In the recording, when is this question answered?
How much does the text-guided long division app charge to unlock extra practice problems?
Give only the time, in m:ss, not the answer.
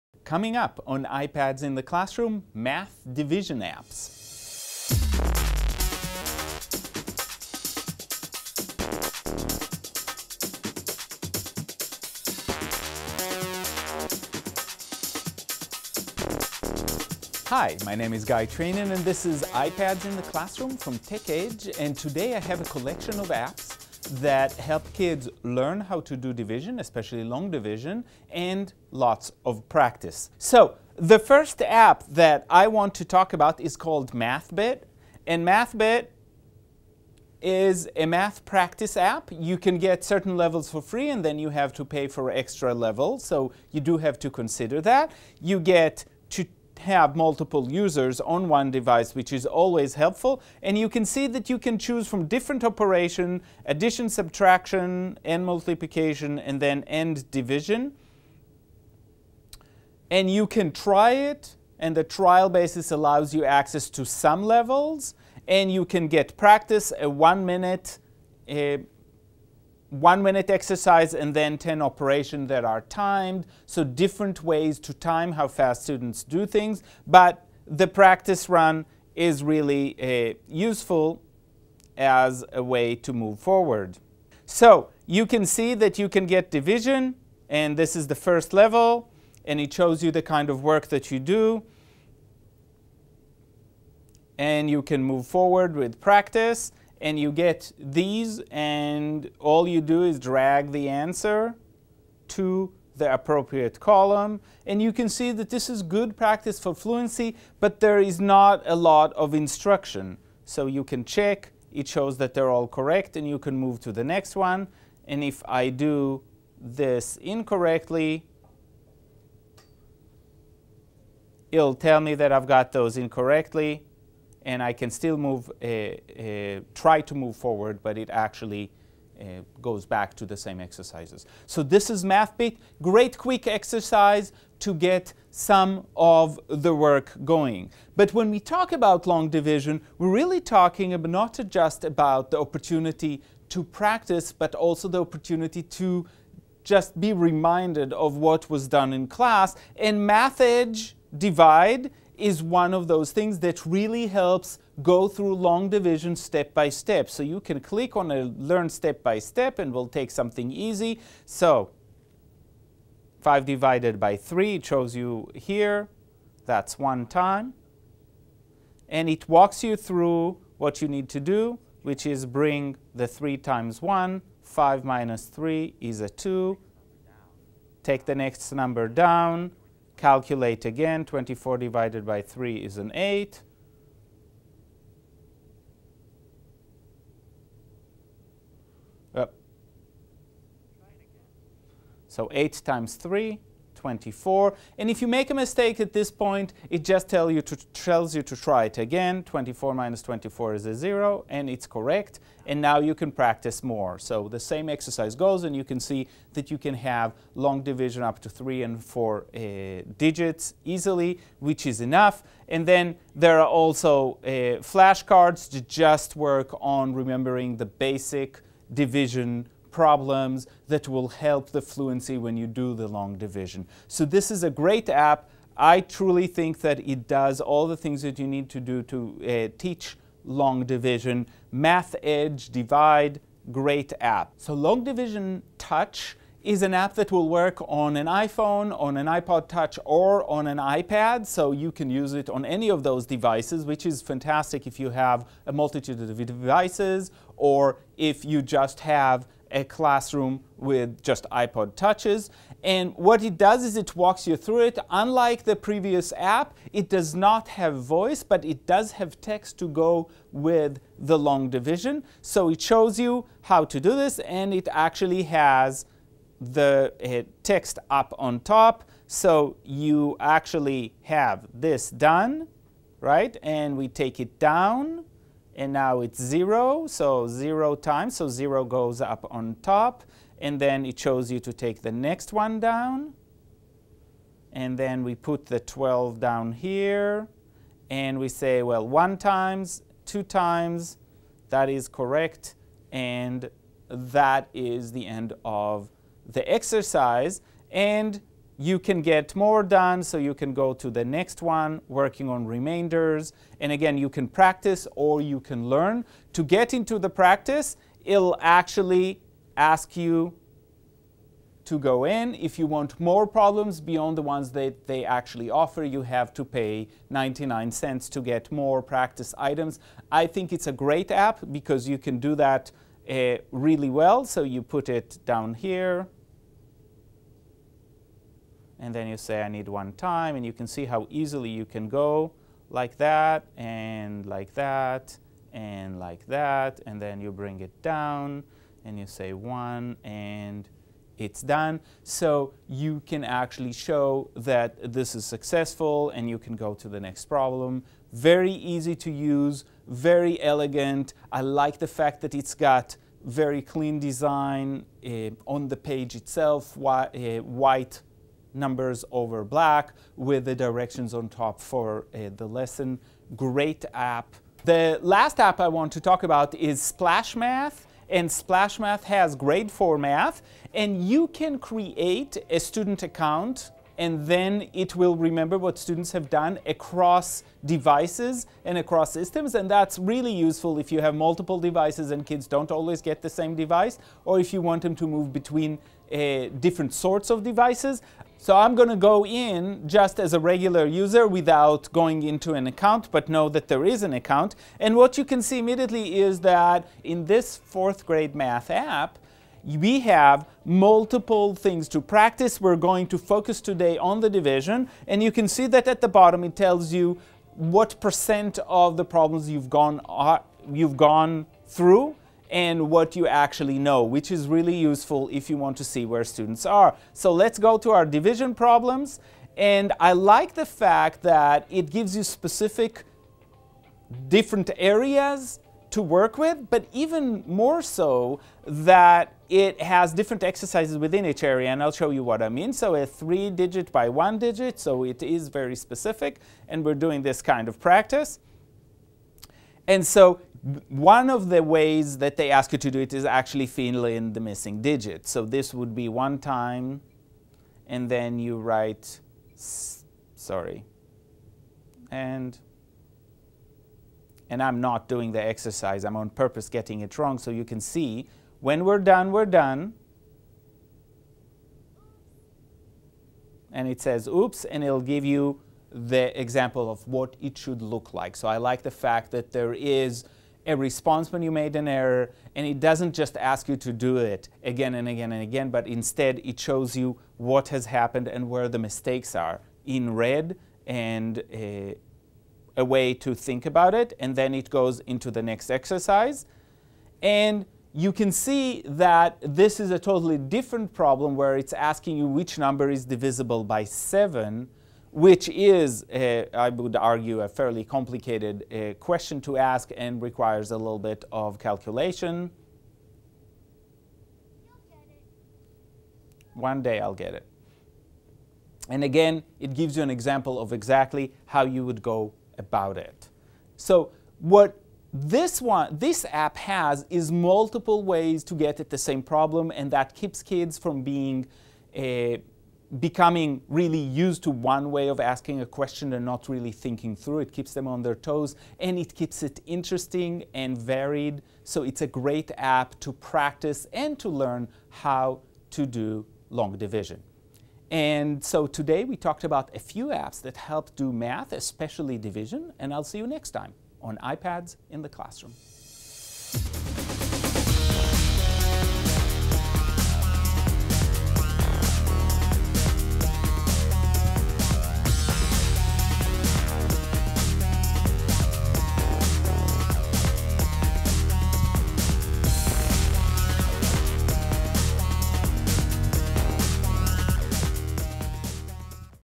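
5:17.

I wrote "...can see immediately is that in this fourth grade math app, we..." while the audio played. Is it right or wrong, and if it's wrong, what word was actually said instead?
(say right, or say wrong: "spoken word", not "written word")
right.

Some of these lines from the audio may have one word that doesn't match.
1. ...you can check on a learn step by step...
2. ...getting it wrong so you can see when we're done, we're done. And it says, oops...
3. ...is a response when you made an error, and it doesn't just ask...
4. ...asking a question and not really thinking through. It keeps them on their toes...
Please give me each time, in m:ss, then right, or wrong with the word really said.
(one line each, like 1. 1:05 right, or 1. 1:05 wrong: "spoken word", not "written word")
1. 2:37 wrong: "click", not "check"
2. 7:36 right
3. 7:49 right
4. 8:45 right.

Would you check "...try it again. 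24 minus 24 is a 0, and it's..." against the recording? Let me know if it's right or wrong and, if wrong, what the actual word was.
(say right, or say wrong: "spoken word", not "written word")
right.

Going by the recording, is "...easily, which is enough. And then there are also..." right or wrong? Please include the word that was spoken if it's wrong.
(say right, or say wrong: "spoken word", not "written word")
right.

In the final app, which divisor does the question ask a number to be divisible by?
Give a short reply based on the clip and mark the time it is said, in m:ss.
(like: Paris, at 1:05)
7, at 8:13.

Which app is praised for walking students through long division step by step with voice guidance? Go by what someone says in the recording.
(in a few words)
MathEdge Divide.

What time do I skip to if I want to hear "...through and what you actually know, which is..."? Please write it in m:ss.
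6:51.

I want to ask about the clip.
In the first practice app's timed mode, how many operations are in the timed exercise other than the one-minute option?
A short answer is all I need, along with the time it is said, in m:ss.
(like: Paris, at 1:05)
10, at 1:11.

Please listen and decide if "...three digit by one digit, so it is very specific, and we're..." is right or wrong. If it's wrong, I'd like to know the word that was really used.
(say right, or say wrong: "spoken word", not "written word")
right.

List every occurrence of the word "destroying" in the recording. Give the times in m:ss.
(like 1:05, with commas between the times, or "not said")
not said.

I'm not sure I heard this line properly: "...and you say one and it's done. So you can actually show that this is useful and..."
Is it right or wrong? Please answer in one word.
wrong.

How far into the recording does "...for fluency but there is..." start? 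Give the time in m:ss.
1:46.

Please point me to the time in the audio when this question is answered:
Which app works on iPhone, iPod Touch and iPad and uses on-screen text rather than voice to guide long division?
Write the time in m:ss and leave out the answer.
3:54.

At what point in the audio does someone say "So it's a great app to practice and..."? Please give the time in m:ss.
8:51.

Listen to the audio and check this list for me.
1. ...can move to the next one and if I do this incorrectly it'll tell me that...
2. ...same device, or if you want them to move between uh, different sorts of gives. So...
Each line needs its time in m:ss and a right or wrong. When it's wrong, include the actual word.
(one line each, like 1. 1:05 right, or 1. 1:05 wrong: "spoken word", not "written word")
1. 1:53 right
2. 6:23 wrong: "devices", not "gives".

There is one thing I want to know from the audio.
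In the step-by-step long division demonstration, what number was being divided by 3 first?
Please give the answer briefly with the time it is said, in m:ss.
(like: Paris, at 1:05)
5, at 2:43.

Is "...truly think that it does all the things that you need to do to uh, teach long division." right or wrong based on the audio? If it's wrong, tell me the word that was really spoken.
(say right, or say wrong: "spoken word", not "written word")
right.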